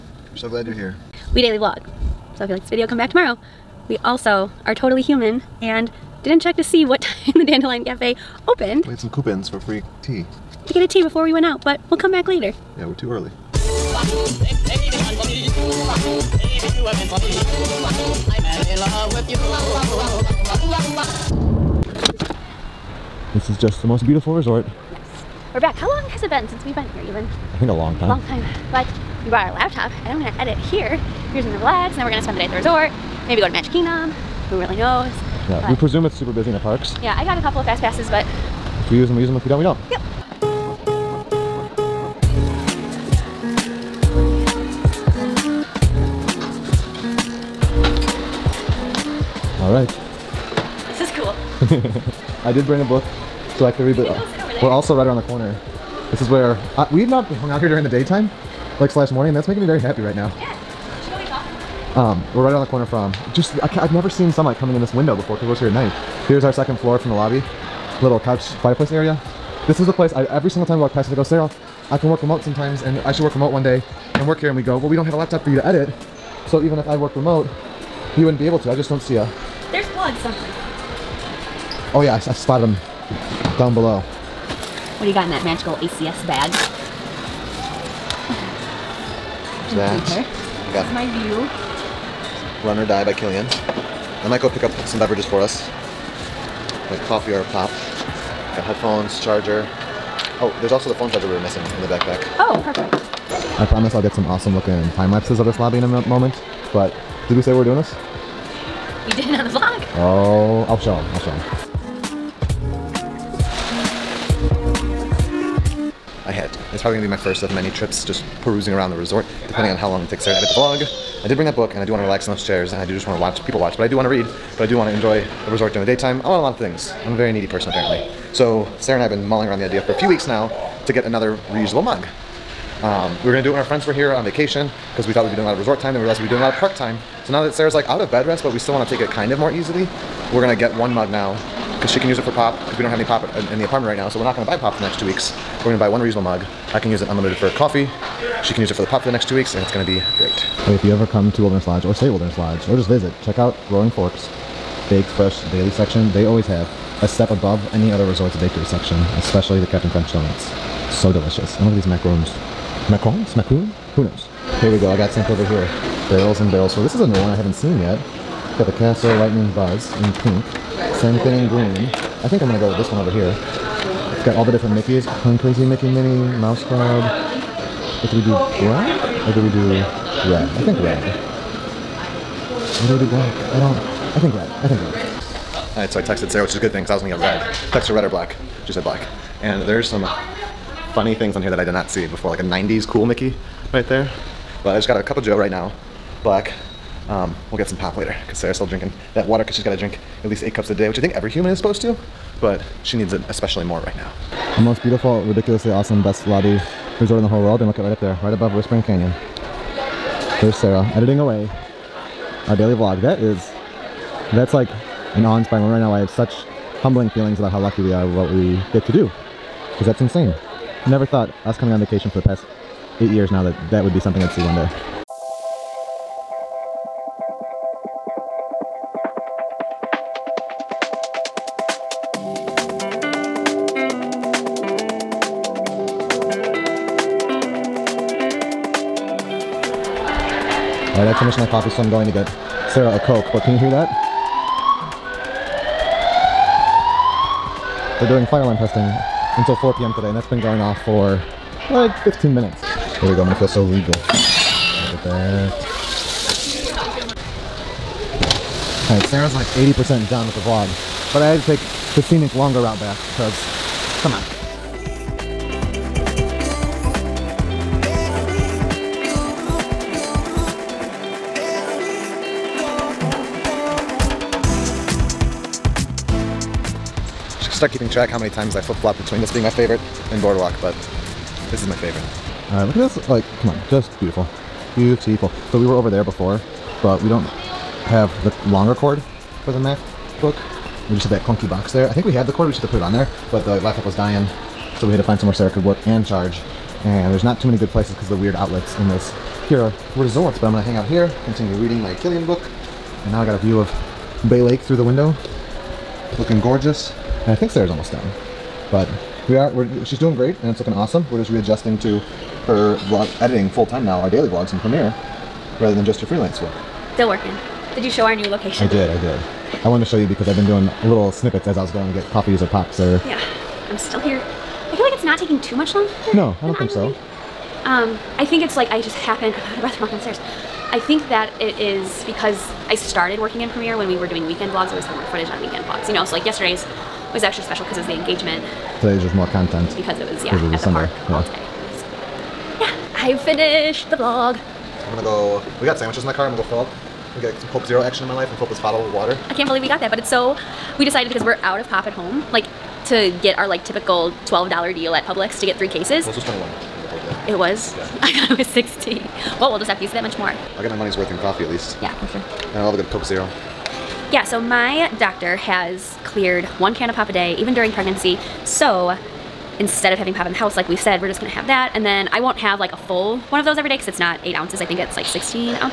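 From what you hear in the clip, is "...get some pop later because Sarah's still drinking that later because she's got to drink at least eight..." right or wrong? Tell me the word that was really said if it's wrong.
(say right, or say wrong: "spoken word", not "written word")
wrong: "water", not "later".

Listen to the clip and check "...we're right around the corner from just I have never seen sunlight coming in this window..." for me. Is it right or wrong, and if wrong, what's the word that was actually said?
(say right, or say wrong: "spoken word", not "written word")
right.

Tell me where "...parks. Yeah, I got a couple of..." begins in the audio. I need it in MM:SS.
00:36.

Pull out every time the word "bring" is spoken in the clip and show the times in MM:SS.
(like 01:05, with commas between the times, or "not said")
00:52, 02:01.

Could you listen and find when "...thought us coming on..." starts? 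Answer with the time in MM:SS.
03:41.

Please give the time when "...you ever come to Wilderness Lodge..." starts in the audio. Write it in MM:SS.
02:30.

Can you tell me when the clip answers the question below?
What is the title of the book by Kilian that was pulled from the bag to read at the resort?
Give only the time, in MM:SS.
01:32.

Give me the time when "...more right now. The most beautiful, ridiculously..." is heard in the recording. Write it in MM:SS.
03:23.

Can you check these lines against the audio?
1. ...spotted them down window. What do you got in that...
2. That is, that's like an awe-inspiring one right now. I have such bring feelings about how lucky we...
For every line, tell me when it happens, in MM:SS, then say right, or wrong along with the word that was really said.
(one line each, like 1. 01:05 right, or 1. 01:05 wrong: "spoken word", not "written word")
1. 01:22 wrong: "below", not "window"
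2. 03:33 wrong: "humbling", not "bring".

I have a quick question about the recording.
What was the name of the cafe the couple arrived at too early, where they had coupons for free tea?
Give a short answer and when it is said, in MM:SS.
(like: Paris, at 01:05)
Dandelion Cafe, at 00:07.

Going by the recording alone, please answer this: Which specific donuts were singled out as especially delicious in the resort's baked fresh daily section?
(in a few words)
Captain Crunch donuts.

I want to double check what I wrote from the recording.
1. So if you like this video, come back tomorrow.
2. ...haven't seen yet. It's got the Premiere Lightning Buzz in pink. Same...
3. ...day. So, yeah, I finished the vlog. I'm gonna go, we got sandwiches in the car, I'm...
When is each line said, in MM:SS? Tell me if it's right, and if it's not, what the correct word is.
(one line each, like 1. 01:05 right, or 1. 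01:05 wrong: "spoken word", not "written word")
1. 00:02 right
2. 02:47 wrong: "Castle", not "Premiere"
3. 05:41 right.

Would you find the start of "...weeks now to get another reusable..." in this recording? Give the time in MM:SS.
02:10.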